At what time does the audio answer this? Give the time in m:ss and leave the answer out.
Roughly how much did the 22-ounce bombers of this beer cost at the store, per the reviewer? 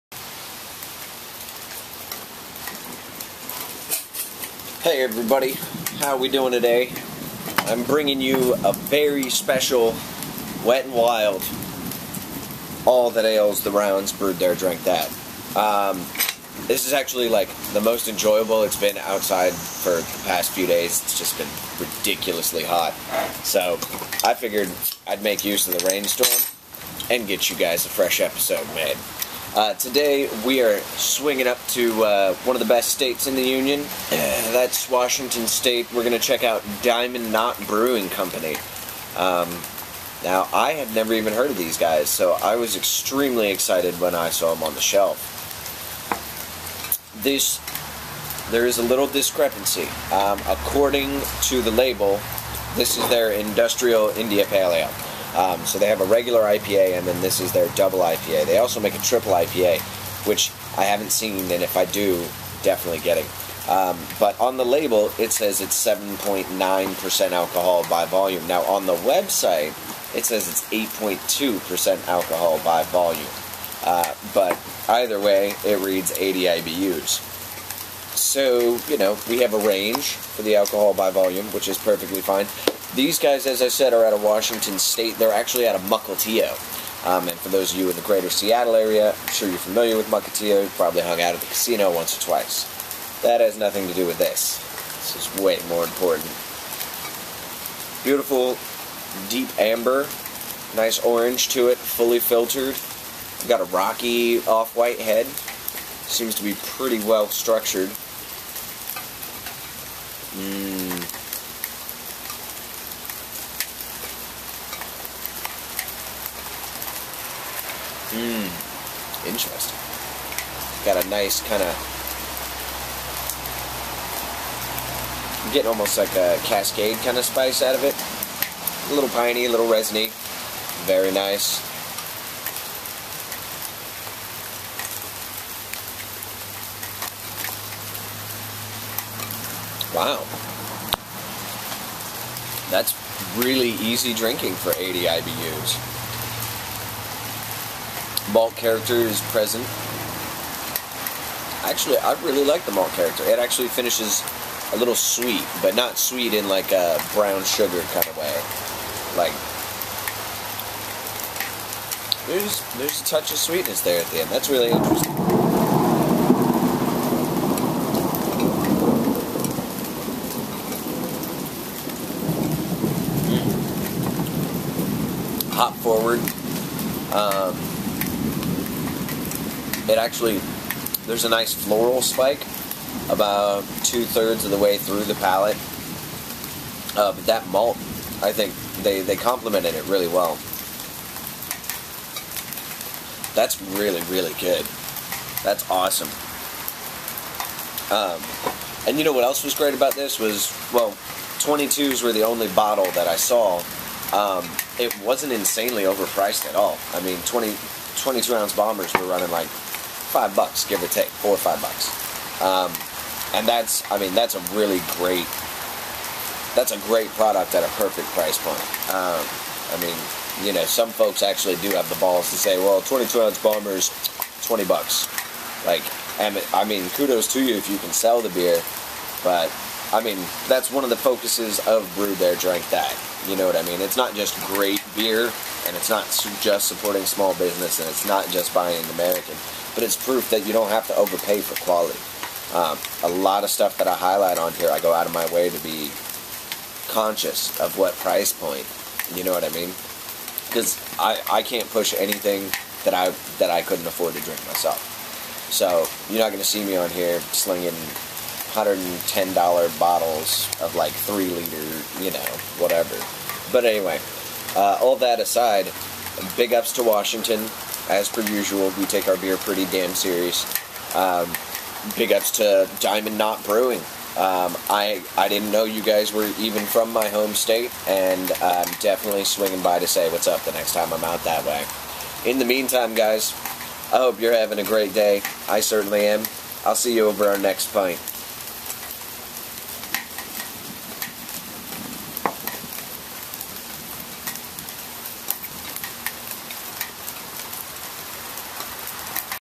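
3:31.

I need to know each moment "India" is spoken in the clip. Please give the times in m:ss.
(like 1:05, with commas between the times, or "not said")
0:54.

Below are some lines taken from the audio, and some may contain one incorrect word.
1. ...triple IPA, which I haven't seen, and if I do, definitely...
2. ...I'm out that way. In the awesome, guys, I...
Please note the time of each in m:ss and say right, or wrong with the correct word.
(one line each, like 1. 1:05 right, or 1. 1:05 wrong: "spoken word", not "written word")
1. 0:59 right
2. 4:40 wrong: "meantime", not "awesome".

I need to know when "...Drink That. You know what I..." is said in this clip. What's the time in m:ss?
3:52.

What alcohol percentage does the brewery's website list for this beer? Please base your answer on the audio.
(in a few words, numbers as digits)
8.2%.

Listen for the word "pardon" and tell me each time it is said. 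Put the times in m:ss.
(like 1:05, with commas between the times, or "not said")
not said.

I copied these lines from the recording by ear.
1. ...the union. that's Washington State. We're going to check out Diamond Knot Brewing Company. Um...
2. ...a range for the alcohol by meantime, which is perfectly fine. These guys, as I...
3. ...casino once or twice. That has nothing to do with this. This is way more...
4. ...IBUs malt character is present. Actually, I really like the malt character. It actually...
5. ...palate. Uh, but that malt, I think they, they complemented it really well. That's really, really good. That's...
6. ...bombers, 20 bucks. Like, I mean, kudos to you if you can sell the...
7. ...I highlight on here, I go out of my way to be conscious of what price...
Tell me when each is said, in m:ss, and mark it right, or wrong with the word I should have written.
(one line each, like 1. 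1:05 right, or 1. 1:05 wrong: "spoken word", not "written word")
1. 0:33 right
2. 1:19 wrong: "volume", not "meantime"
3. 1:31 right
4. 2:25 right
5. 3:05 right
6. 3:43 right
7. 4:03 right.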